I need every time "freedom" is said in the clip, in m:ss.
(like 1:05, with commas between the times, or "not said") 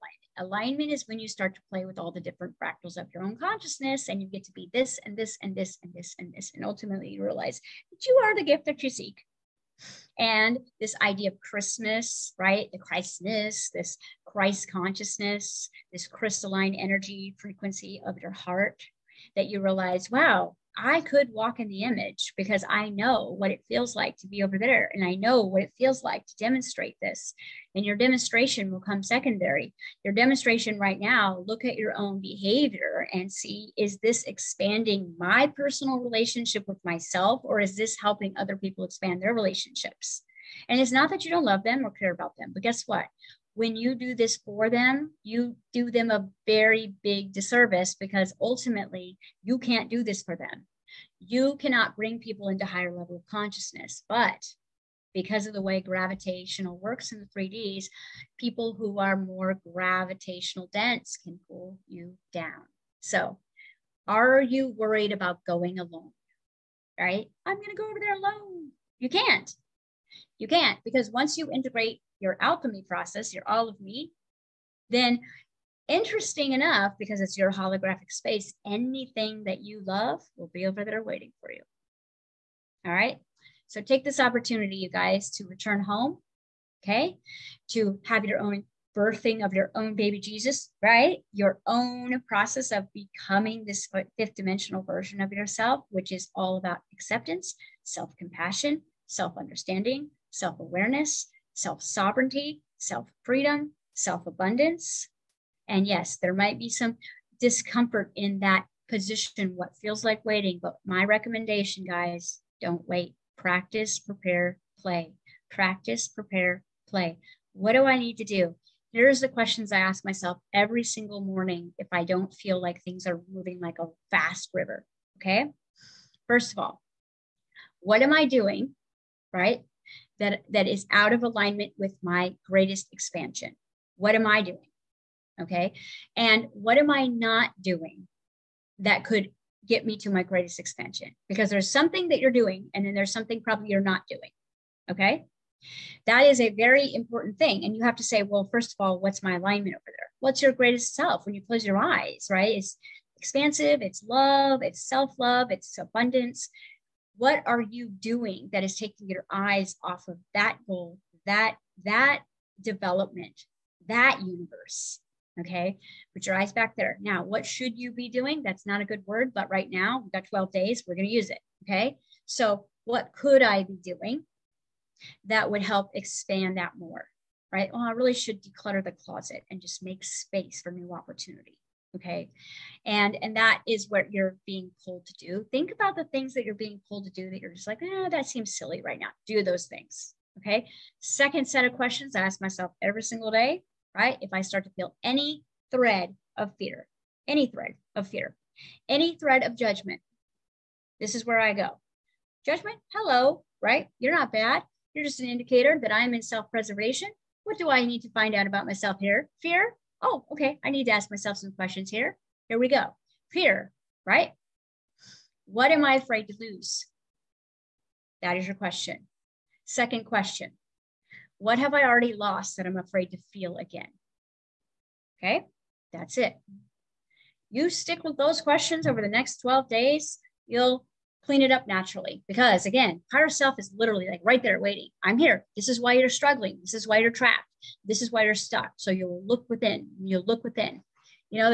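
1:43.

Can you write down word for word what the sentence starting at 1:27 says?
To have your own birthing of your own baby Jesus, right?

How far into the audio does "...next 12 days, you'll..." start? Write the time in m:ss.
3:49.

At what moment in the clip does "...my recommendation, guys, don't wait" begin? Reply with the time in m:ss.
1:50.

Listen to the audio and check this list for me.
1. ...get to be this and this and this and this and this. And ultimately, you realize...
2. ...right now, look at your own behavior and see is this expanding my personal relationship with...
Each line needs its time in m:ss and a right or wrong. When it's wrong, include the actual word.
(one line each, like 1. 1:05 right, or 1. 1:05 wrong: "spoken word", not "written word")
1. 0:04 right
2. 0:30 right.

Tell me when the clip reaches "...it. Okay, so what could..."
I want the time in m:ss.
2:51.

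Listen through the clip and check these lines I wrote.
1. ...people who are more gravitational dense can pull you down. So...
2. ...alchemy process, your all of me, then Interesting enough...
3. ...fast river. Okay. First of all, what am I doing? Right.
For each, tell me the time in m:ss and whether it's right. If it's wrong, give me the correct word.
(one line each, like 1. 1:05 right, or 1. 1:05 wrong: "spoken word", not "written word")
1. 0:58 right
2. 1:12 right
3. 2:04 right.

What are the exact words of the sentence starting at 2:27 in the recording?
And you have to say, well, first of all, what's my alignment over there?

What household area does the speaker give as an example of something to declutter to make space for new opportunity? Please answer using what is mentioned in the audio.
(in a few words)
The closet.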